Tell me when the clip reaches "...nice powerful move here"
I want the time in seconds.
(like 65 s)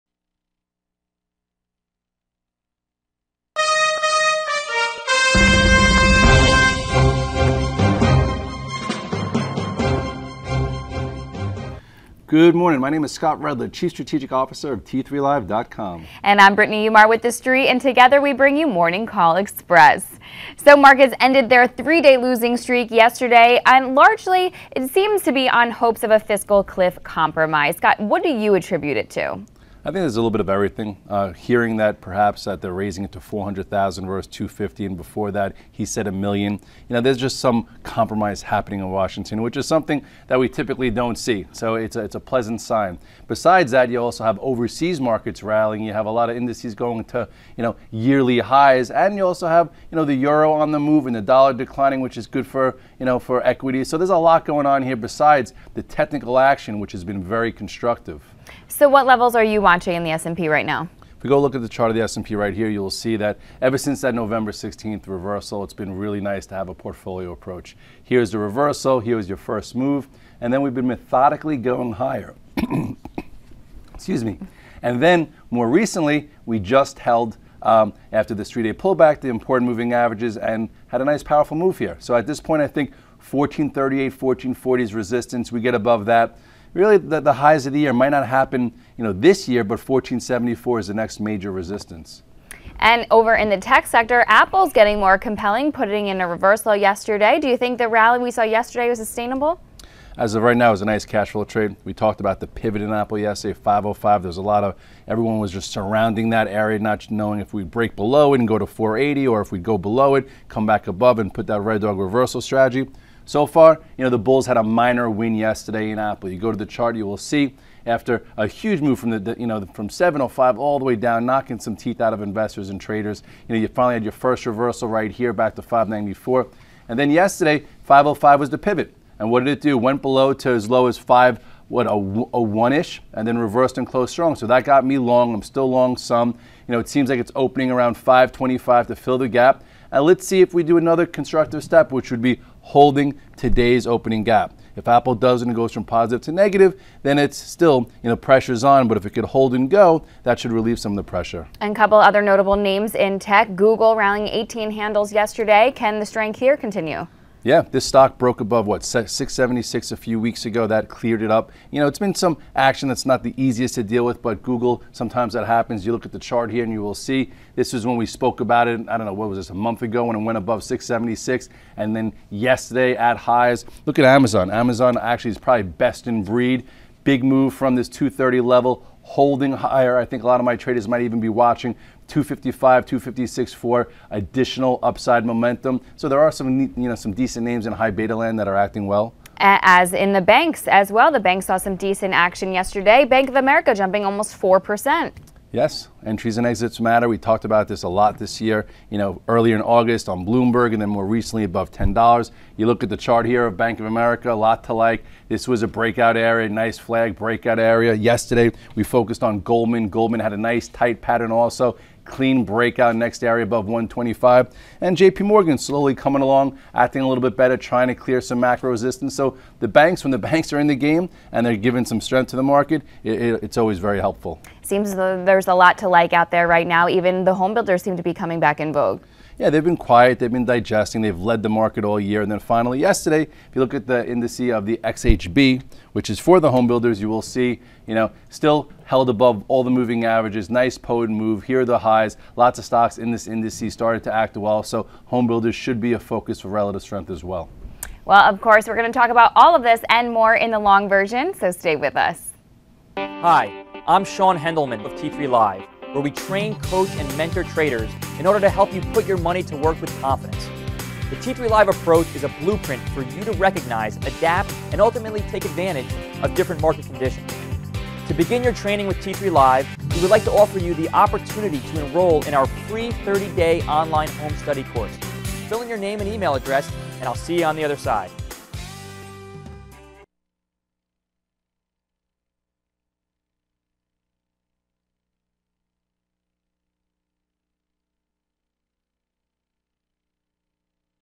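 81 s.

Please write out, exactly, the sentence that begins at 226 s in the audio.
Even the home builders seem to be coming back in vogue.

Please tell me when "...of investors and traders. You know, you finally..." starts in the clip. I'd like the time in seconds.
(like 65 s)
122 s.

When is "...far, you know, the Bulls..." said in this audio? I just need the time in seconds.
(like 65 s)
113 s.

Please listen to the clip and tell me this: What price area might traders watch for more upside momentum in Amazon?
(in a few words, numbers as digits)
255, 256.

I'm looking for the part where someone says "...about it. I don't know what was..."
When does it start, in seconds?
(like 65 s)
168 s.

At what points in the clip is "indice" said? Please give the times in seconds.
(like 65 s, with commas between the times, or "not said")
46 s, 234 s, 243 s.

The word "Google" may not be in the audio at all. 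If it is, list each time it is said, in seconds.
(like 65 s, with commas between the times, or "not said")
153 s, 164 s.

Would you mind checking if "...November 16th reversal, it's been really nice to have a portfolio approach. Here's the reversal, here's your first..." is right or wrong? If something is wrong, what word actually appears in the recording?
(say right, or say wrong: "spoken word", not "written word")
right.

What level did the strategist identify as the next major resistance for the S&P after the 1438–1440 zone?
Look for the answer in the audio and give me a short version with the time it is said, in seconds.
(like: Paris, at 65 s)
1474, at 89 s.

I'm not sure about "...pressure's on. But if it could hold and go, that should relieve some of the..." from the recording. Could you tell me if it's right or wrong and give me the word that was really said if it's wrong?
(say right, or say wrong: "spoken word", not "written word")
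right.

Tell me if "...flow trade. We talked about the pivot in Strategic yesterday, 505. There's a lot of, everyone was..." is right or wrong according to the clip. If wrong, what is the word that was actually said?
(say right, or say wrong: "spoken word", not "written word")
wrong: "Apple", not "Strategic".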